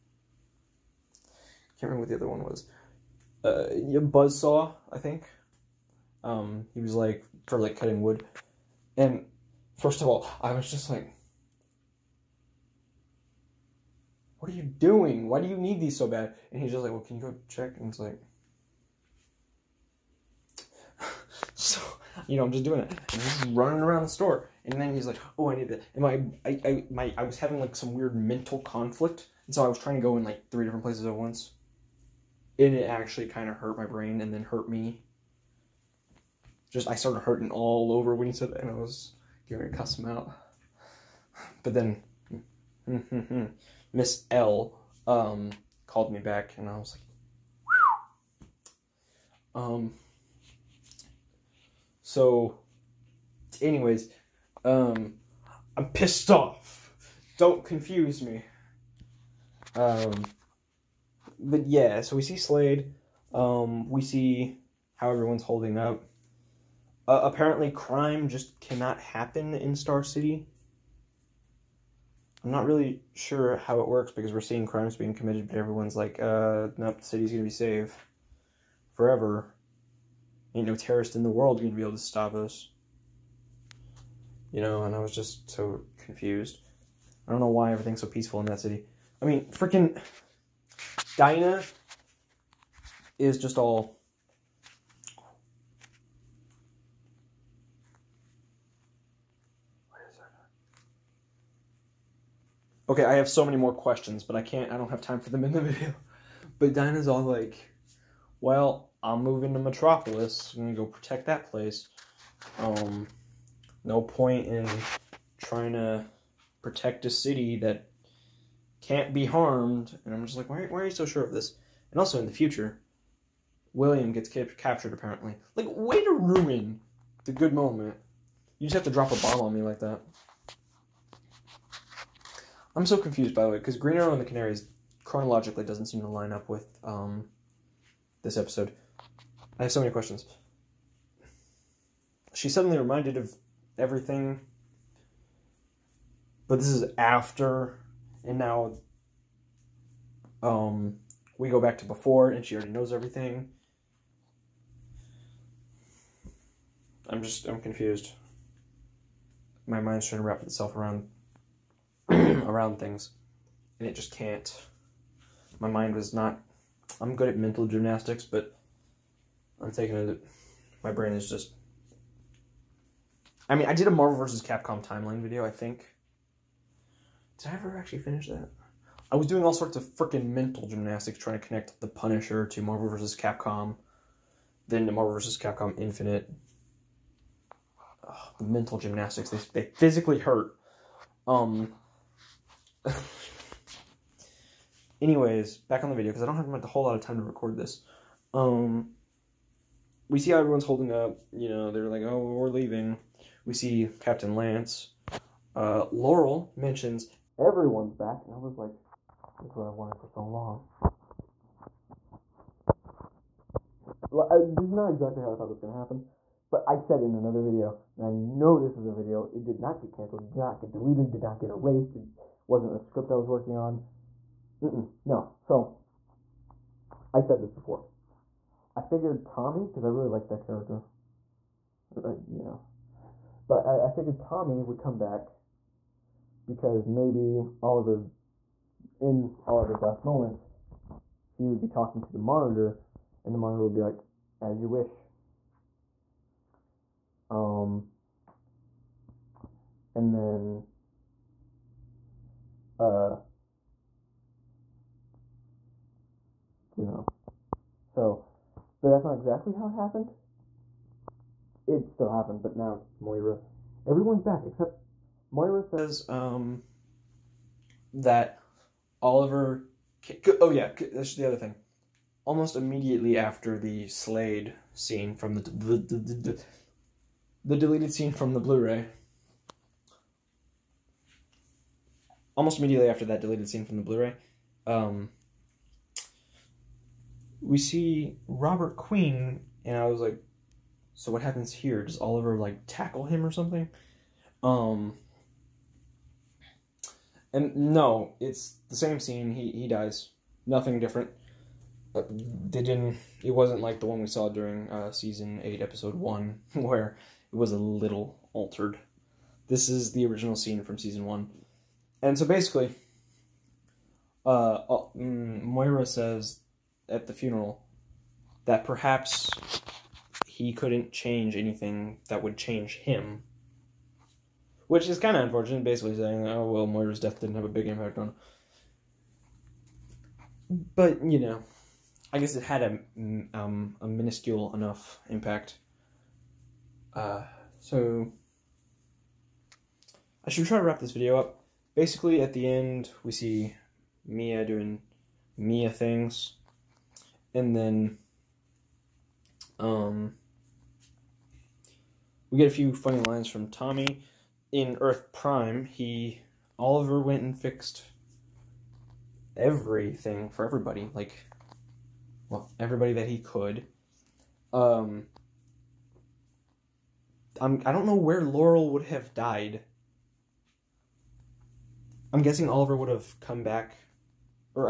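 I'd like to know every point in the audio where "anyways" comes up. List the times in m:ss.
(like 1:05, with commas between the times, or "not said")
0:53, 3:15.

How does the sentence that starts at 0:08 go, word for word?
And first of all, I was just like, what are you doing?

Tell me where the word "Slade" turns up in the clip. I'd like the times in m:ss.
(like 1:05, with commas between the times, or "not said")
1:02, 4:33.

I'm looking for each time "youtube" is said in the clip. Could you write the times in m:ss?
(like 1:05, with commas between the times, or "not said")
not said.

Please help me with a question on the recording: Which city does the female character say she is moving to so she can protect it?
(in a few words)
Metropolis.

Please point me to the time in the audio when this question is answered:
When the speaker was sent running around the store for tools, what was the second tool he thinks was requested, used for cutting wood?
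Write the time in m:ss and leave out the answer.
0:03.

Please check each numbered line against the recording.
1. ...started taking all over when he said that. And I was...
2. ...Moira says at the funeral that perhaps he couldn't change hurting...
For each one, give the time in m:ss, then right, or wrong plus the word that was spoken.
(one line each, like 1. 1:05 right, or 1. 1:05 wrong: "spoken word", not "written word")
1. 0:36 wrong: "hurting", not "taking"
2. 5:15 wrong: "anything", not "hurting".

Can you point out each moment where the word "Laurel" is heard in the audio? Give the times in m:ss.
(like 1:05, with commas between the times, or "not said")
3:25, 6:08.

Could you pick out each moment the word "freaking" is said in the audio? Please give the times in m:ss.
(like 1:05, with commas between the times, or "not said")
1:29, 2:59.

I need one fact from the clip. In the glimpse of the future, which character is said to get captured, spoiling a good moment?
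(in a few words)
William.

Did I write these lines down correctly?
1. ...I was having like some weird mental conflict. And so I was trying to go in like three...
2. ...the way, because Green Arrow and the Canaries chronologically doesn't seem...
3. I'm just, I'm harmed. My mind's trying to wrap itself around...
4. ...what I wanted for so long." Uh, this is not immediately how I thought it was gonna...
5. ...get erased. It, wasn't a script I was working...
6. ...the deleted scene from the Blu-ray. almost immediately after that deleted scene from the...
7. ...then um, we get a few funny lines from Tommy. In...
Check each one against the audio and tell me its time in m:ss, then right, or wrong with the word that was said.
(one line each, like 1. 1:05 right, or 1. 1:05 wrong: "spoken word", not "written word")
1. 0:27 right
2. 2:13 right
3. 2:37 wrong: "confused", not "harmed"
4. 3:29 wrong: "exactly", not "immediately"
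5. 3:41 right
6. 4:37 right
7. 5:47 right.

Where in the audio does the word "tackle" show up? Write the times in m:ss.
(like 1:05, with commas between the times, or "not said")
4:52.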